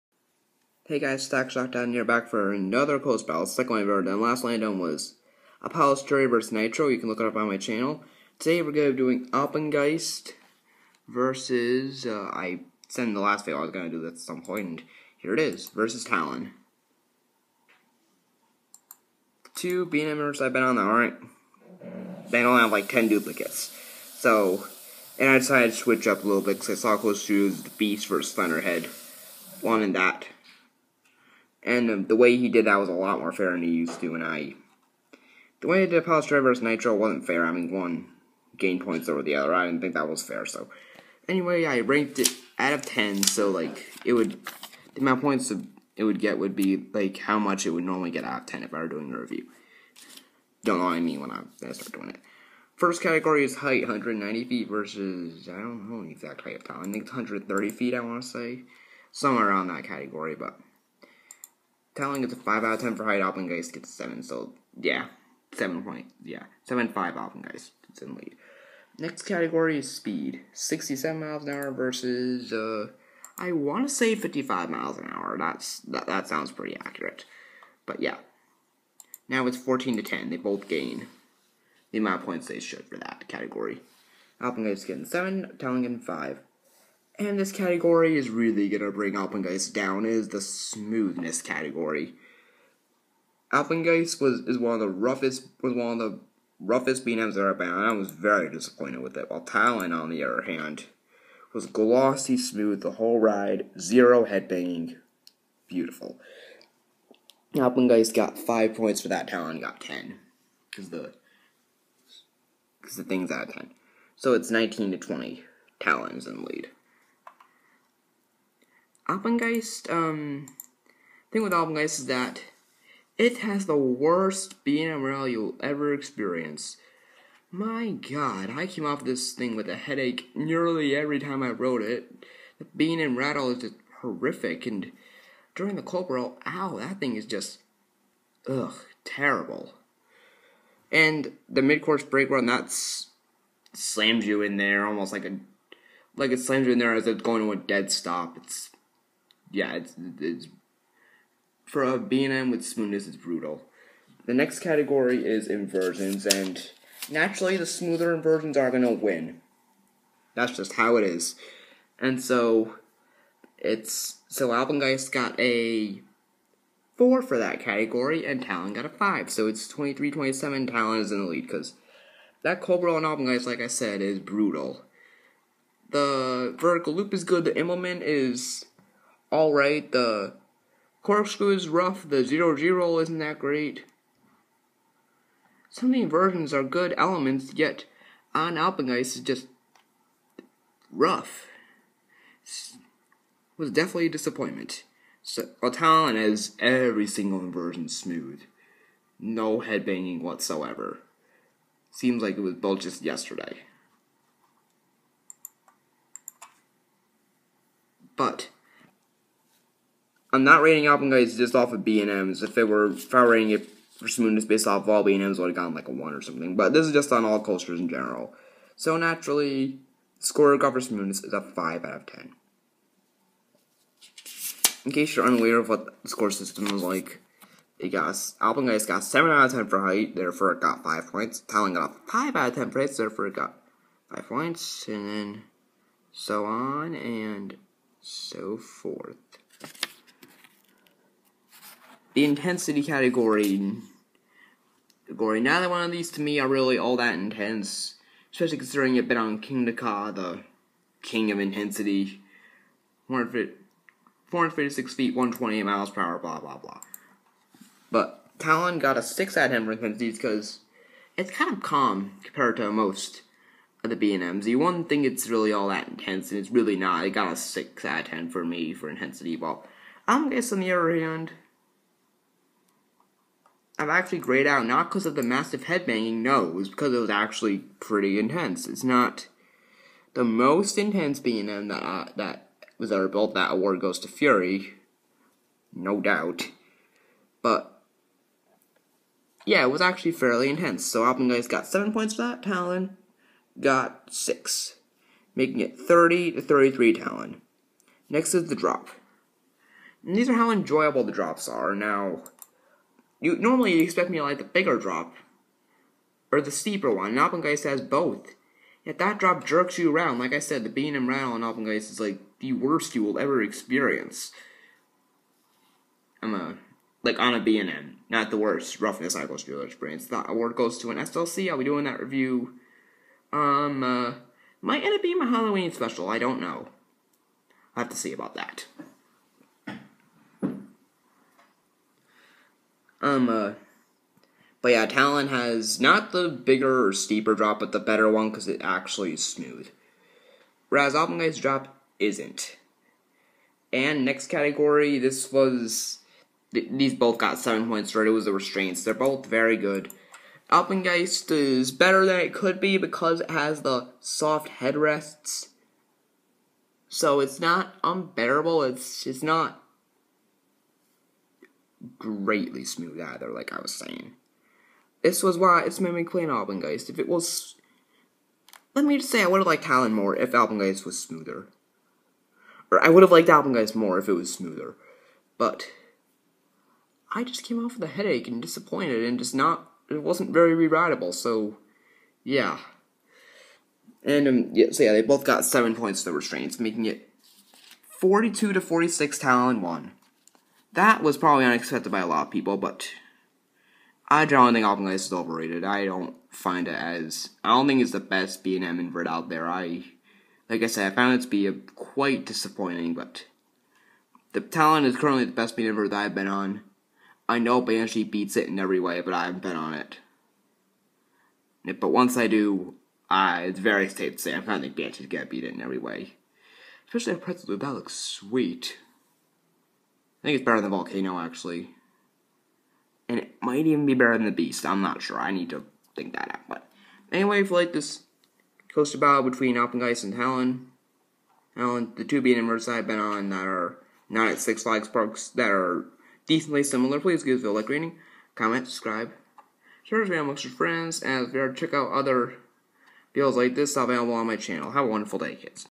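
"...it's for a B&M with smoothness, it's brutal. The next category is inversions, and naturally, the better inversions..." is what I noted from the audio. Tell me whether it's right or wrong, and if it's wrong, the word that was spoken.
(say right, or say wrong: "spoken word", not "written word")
wrong: "smoother", not "better".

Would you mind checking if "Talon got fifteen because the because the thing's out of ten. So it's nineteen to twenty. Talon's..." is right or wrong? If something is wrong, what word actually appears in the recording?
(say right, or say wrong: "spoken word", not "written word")
wrong: "ten", not "fifteen".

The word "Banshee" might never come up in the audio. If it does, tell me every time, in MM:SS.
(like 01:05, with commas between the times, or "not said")
06:47, 06:54.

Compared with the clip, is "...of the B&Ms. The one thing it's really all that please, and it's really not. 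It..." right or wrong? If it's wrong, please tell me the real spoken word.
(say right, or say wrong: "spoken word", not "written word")
wrong: "intense", not "please".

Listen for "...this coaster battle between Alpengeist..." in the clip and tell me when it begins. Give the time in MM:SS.
07:07.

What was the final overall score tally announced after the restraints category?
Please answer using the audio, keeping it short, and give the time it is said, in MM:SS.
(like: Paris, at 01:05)
42 to 46, at 06:27.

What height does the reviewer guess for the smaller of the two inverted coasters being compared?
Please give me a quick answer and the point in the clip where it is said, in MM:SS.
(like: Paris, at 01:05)
130 feet, at 00:57.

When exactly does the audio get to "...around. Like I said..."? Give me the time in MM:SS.
05:09.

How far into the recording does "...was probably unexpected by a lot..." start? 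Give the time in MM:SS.
06:31.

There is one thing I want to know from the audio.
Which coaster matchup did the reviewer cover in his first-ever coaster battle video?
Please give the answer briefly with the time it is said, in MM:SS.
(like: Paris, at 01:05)
Apollo's Chariot vs. Nitro, at 00:05.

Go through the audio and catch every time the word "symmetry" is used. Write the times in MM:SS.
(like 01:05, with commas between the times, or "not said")
not said.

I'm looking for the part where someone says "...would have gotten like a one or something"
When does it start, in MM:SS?
03:35.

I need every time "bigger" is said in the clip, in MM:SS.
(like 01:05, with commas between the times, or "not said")
05:04, 05:36.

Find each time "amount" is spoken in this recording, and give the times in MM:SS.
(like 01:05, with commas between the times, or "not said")
00:45, 01:21.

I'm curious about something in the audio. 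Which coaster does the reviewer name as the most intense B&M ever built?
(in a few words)
Fury.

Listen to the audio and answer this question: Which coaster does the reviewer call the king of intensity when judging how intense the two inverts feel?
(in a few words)
Kingda Ka.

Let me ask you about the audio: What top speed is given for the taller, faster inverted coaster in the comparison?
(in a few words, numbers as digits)
67 miles an hour.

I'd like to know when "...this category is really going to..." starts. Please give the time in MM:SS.
01:27.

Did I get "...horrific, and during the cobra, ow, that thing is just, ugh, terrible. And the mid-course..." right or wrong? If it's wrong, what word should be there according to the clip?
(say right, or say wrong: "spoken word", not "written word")
right.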